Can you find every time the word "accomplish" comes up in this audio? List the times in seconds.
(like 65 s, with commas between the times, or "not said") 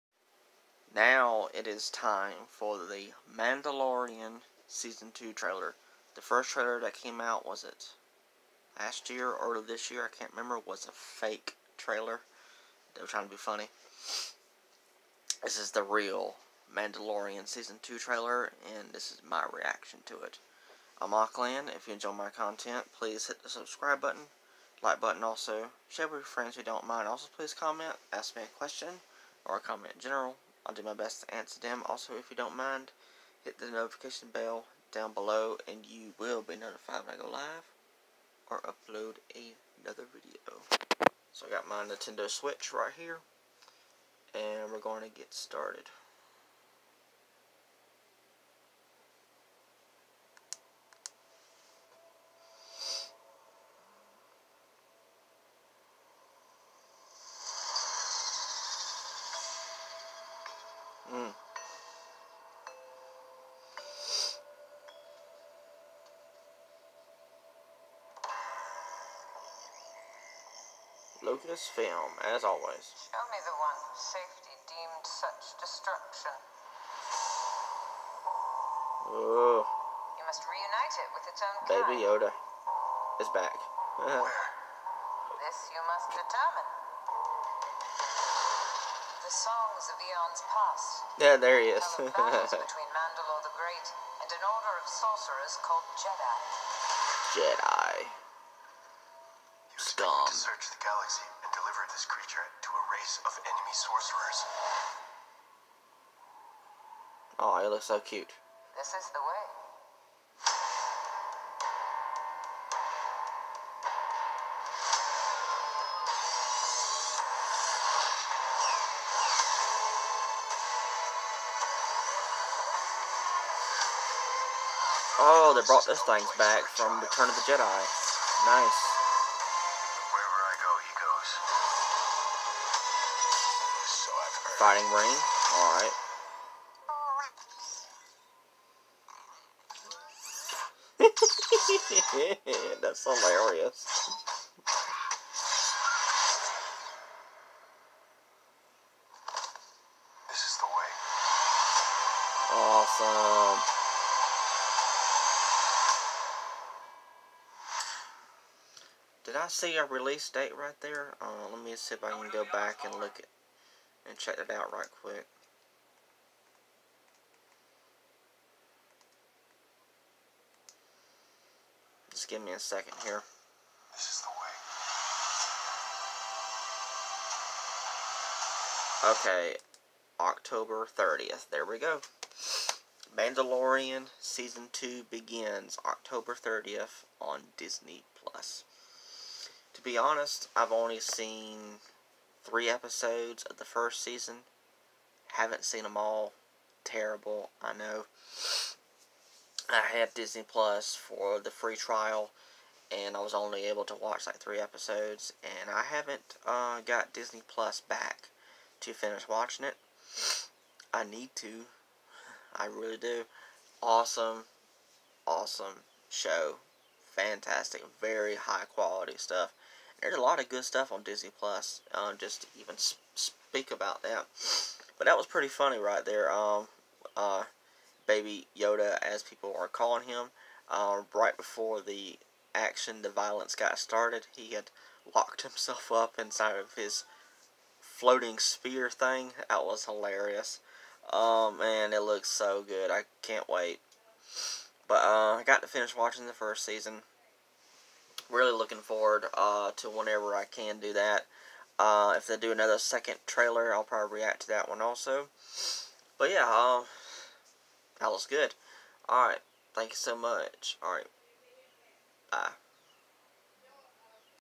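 not said.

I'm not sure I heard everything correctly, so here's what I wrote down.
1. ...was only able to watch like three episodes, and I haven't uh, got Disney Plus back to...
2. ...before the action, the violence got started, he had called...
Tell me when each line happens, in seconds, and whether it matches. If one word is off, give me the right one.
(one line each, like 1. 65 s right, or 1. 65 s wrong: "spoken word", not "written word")
1. 203 s right
2. 231 s wrong: "locked", not "called".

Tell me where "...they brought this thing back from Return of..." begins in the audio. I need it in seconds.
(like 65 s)
125 s.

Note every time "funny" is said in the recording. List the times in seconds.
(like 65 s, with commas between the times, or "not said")
13 s, 225 s.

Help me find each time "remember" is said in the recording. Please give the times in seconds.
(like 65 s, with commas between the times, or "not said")
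10 s.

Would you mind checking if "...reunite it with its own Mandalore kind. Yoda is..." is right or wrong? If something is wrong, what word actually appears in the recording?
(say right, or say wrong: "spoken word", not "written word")
wrong: "Baby", not "Mandalore".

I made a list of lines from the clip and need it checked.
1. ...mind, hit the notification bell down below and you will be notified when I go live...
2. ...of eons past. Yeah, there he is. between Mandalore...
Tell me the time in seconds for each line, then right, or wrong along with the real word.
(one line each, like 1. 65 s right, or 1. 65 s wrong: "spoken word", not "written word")
1. 32 s right
2. 89 s right.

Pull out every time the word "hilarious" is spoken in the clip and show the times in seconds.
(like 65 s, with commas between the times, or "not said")
143 s, 239 s.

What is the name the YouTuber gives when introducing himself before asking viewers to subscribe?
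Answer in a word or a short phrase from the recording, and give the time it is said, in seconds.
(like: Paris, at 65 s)
Aqland, at 21 s.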